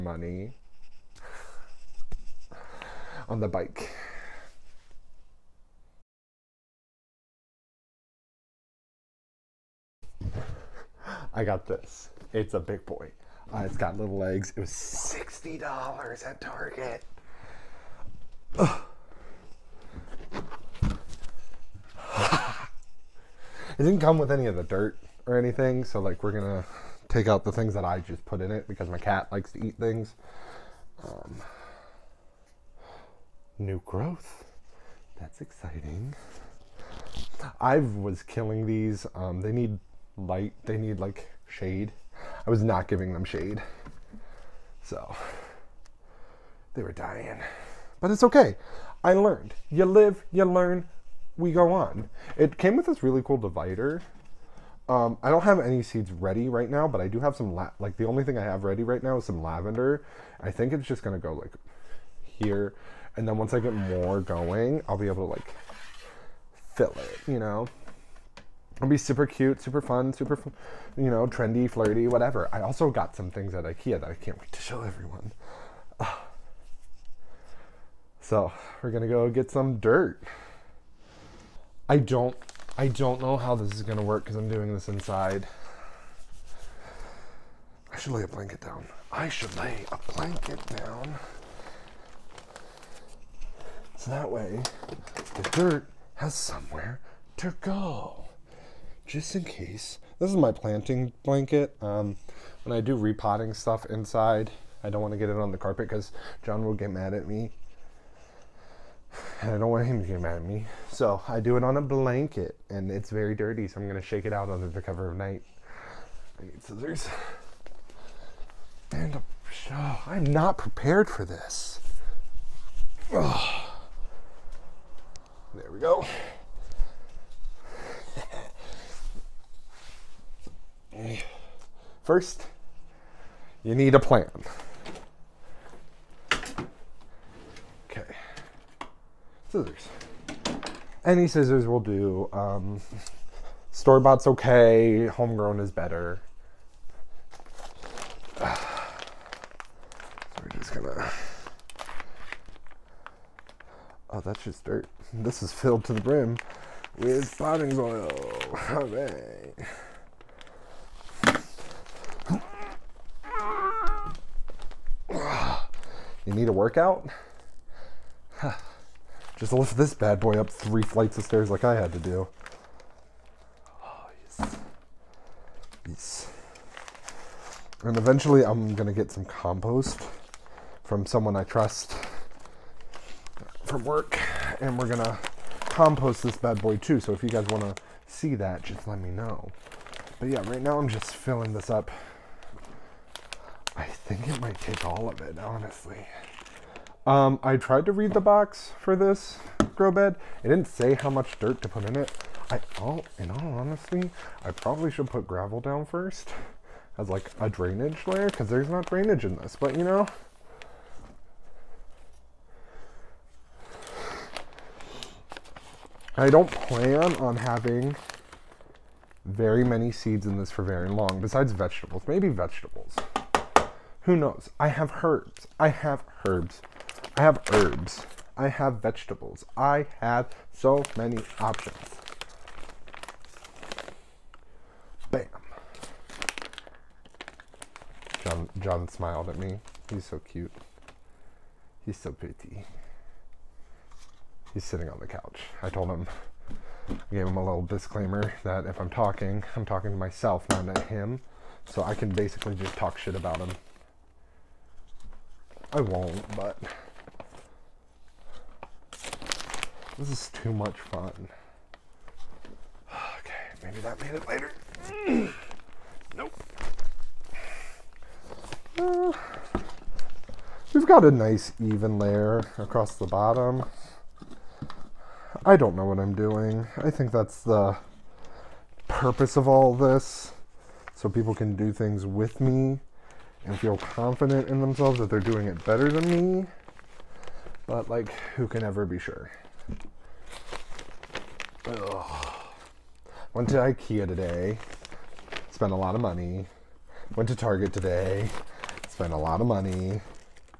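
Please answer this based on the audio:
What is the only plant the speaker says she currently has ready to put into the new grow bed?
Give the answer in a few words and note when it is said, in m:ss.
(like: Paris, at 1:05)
Lavender, at 0:59.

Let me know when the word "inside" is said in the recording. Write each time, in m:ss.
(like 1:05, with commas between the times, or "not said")
1:24, 1:43.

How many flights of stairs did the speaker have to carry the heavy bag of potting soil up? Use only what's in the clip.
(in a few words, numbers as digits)
3.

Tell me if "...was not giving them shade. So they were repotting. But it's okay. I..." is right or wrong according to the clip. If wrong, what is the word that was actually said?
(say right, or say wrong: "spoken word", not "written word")
wrong: "dying", not "repotting".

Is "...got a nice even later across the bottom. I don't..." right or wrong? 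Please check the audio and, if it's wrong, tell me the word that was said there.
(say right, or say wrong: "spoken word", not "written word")
wrong: "layer", not "later".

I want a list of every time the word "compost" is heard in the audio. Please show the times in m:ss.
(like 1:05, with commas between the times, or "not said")
2:59, 3:05.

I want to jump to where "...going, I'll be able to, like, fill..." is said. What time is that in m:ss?
1:04.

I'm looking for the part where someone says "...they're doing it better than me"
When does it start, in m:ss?
4:45.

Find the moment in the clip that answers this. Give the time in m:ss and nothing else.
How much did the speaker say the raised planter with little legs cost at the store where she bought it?
0:14.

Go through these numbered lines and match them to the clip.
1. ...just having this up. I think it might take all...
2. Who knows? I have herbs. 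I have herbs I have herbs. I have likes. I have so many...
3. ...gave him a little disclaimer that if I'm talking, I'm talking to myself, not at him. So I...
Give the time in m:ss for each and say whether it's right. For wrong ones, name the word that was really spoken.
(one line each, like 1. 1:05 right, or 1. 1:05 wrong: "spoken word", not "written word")
1. 3:10 wrong: "filling", not "having"
2. 3:44 wrong: "vegetables", not "likes"
3. 4:07 right.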